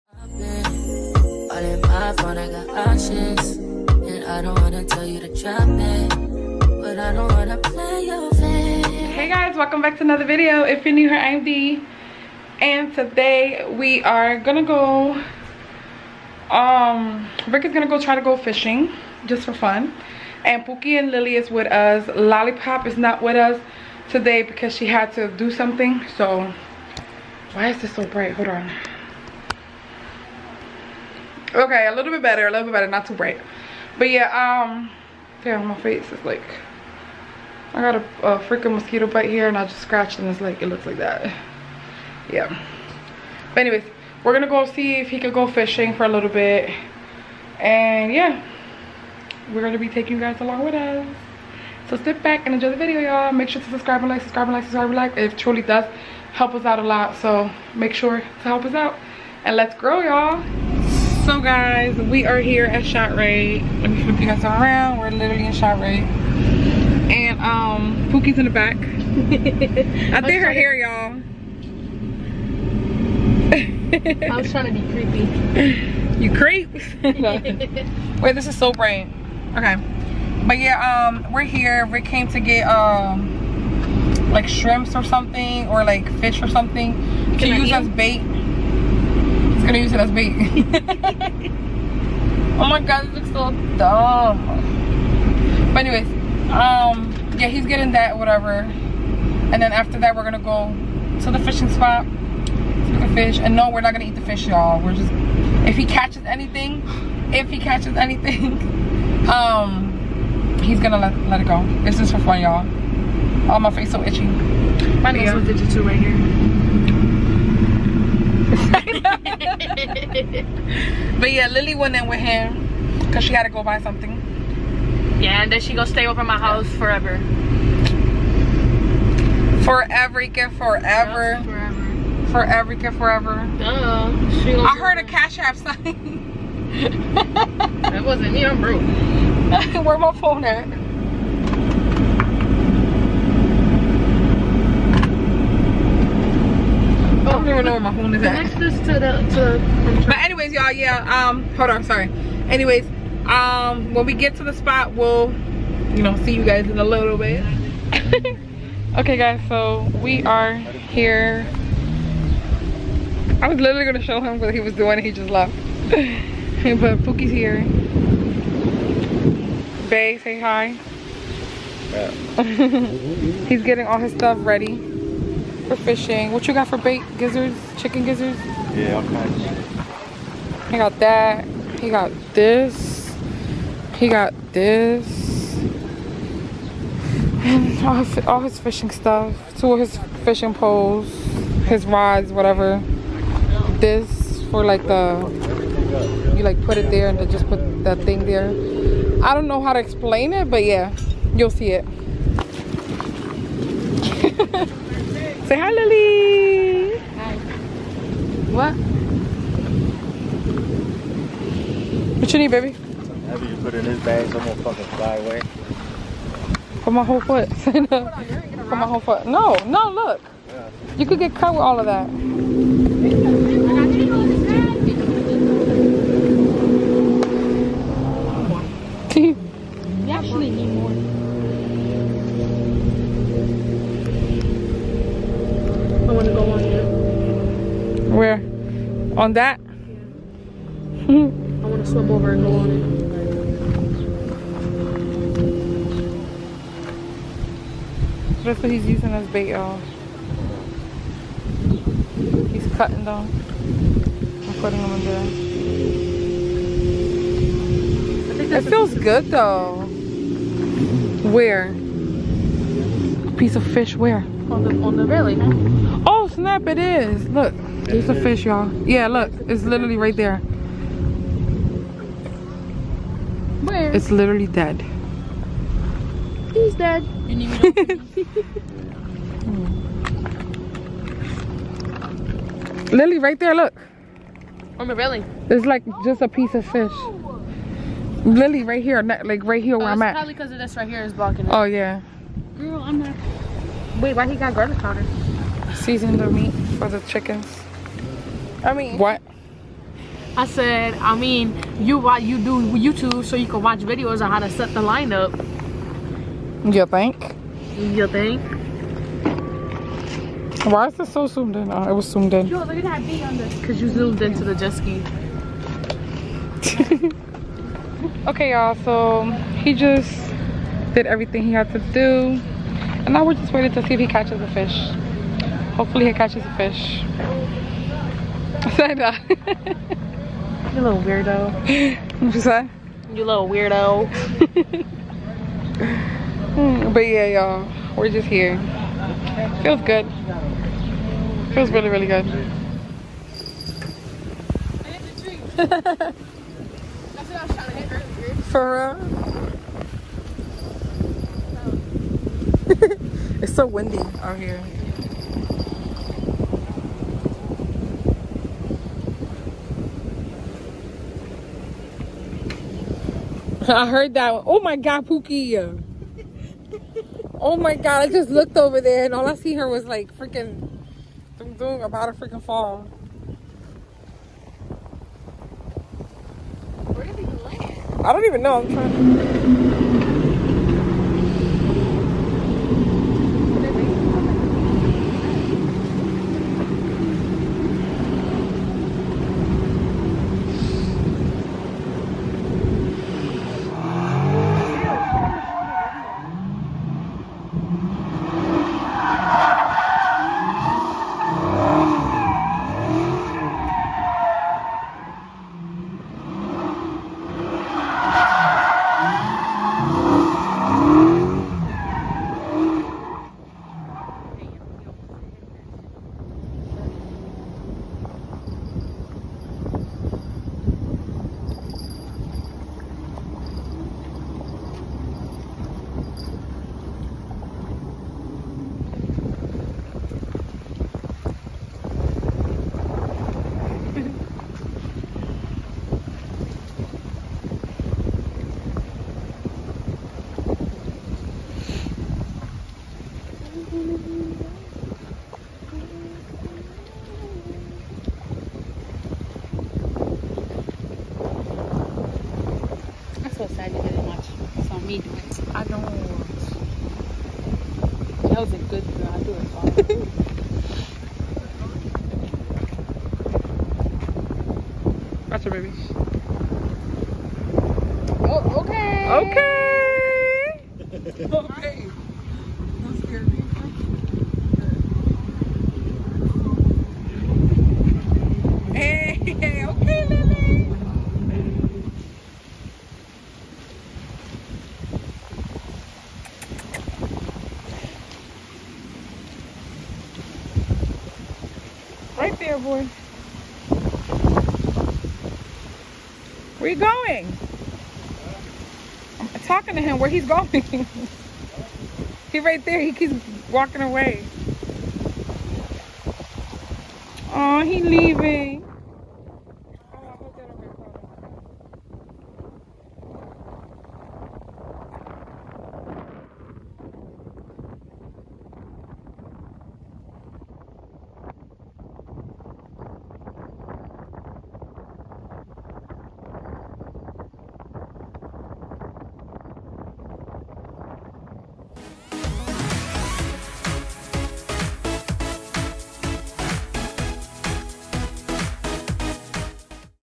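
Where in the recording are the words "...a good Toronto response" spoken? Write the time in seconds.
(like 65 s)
458 s.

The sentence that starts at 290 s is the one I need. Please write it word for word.
Probably because of this right here is blocking it.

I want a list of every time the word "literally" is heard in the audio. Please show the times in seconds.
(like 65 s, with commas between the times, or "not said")
65 s, 163 s, 269 s, 274 s.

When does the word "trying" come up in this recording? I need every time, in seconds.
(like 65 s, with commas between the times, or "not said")
74 s, 378 s.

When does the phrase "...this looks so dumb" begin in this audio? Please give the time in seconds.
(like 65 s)
93 s.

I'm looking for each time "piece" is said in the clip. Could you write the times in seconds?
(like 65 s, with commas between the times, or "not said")
263 s, 286 s.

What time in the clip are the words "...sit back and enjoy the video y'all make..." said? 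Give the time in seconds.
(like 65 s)
51 s.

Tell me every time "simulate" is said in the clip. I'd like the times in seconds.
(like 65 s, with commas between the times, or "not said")
not said.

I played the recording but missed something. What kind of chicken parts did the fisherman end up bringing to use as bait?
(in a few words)
Chicken gizzards.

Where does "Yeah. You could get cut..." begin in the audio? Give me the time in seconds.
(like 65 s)
220 s.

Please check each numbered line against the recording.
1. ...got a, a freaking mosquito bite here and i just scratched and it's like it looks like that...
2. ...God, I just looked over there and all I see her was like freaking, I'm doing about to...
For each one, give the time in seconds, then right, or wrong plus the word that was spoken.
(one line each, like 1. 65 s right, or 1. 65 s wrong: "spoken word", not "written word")
1. 37 s right
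2. 367 s right.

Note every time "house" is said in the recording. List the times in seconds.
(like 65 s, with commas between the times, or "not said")
126 s.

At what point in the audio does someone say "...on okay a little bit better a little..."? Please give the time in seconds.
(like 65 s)
28 s.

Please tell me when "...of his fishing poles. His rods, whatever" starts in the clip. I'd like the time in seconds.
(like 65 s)
189 s.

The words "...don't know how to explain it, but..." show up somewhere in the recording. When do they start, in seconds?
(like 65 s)
199 s.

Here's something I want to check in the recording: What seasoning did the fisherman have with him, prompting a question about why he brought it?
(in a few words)
Garlic powder.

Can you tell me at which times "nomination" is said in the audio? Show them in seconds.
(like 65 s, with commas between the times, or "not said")
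not said.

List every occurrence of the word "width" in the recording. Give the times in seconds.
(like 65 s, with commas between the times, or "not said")
not said.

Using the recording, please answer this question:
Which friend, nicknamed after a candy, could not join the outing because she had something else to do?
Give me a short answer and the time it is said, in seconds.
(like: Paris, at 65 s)
Lollipop, at 22 s.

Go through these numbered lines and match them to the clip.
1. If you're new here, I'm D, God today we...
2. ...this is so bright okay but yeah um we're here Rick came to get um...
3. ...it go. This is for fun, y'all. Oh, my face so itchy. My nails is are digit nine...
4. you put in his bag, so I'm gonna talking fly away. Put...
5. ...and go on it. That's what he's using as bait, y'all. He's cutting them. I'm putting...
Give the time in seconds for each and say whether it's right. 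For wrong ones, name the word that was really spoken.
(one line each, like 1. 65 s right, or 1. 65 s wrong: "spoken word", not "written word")
1. 10 s wrong: "And", not "God"
2. 78 s right
3. 111 s wrong: "two", not "nine"
4. 212 s wrong: "fucking", not "talking"
5. 242 s right.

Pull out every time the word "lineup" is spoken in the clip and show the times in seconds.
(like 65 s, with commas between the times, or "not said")
304 s.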